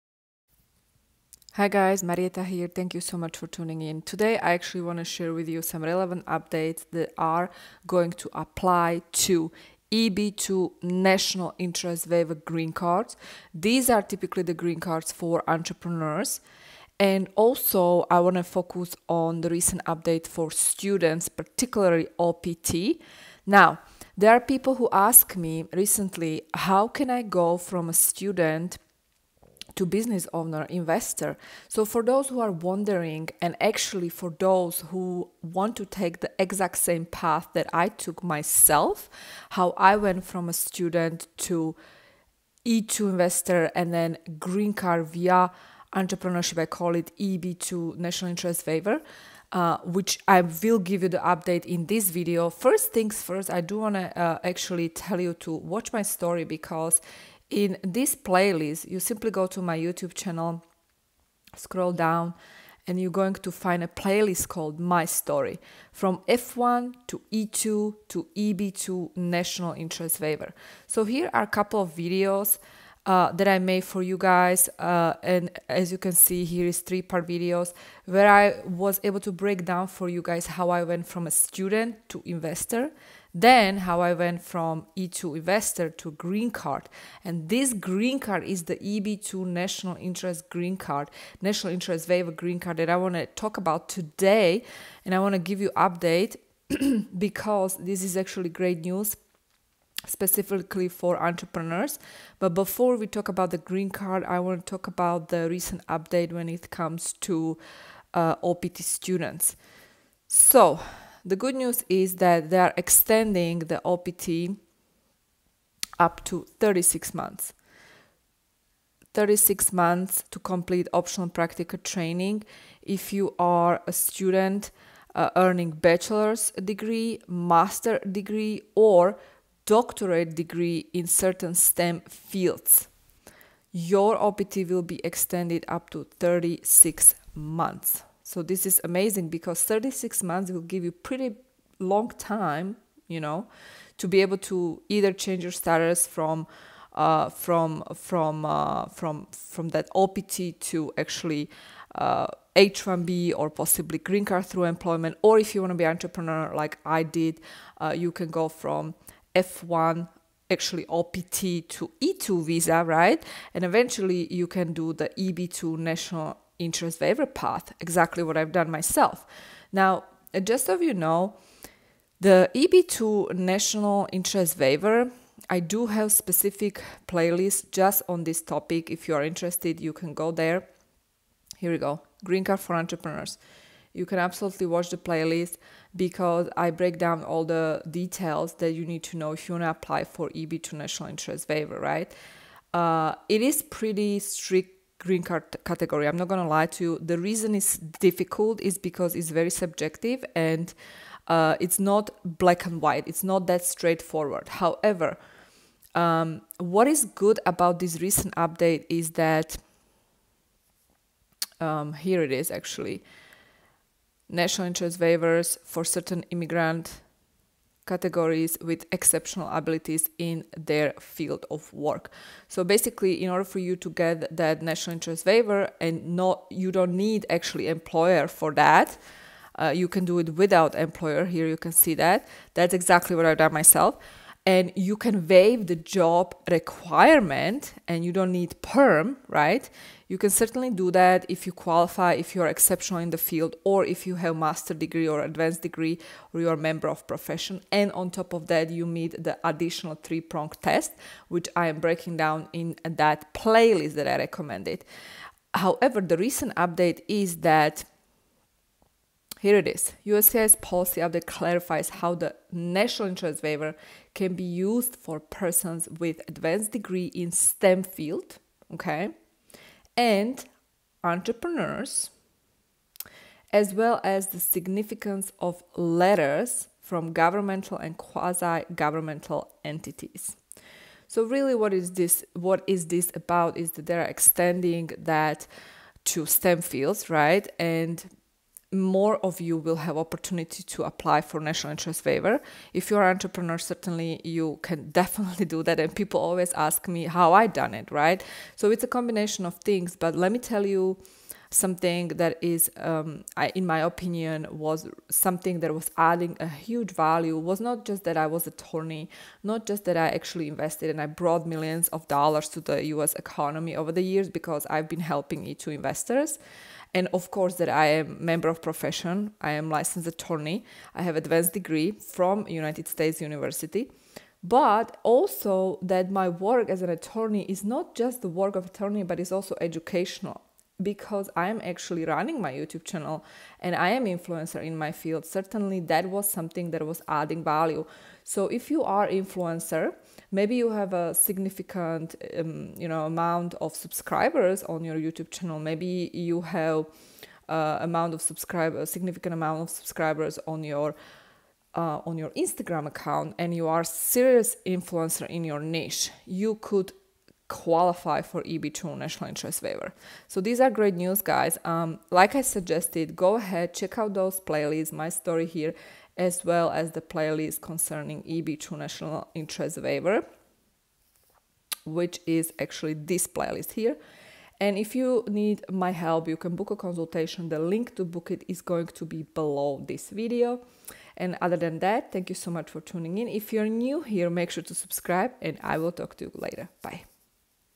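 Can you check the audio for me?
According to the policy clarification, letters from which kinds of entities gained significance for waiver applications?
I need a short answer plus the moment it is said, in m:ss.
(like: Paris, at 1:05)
governmental and quasi-governmental, at 4:37.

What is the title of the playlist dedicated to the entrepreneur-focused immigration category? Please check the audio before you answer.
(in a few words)
Green Card for Entrepreneurs.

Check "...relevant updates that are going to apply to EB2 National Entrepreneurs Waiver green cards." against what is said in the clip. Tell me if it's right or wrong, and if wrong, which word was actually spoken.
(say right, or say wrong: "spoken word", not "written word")
wrong: "Interest", not "Entrepreneurs".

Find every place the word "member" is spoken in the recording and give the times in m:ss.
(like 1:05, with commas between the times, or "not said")
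4:06, 5:18.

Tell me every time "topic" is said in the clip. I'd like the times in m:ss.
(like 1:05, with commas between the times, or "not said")
2:58.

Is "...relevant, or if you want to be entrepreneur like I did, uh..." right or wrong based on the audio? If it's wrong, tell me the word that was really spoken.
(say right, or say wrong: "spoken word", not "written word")
wrong: "employment", not "relevant".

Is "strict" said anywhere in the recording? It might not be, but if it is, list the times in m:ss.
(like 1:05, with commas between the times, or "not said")
3:14.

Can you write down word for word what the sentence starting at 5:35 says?
Certainly that was something that was adding value.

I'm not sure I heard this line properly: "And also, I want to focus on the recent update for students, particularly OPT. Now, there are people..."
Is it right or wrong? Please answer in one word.
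right.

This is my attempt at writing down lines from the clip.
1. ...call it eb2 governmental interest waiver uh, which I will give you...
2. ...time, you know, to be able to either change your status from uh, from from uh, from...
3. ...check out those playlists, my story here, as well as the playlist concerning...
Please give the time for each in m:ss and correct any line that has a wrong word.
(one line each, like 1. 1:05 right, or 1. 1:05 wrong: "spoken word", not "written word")
1. 0:46 wrong: "national", not "governmental"
2. 2:22 right
3. 6:03 right.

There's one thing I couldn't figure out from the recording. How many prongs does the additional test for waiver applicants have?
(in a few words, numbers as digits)
3.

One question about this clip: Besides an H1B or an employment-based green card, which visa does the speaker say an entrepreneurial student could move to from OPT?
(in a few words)
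E2 visa.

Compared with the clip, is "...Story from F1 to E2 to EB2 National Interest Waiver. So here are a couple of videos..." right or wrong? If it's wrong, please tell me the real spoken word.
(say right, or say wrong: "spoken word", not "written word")
right.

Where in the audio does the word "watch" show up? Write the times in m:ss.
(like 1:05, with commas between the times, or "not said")
0:55, 3:04.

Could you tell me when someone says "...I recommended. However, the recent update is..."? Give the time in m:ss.
4:14.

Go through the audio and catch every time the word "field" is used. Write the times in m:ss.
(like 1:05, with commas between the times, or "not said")
2:12, 3:41, 4:03, 4:27, 4:46, 5:34.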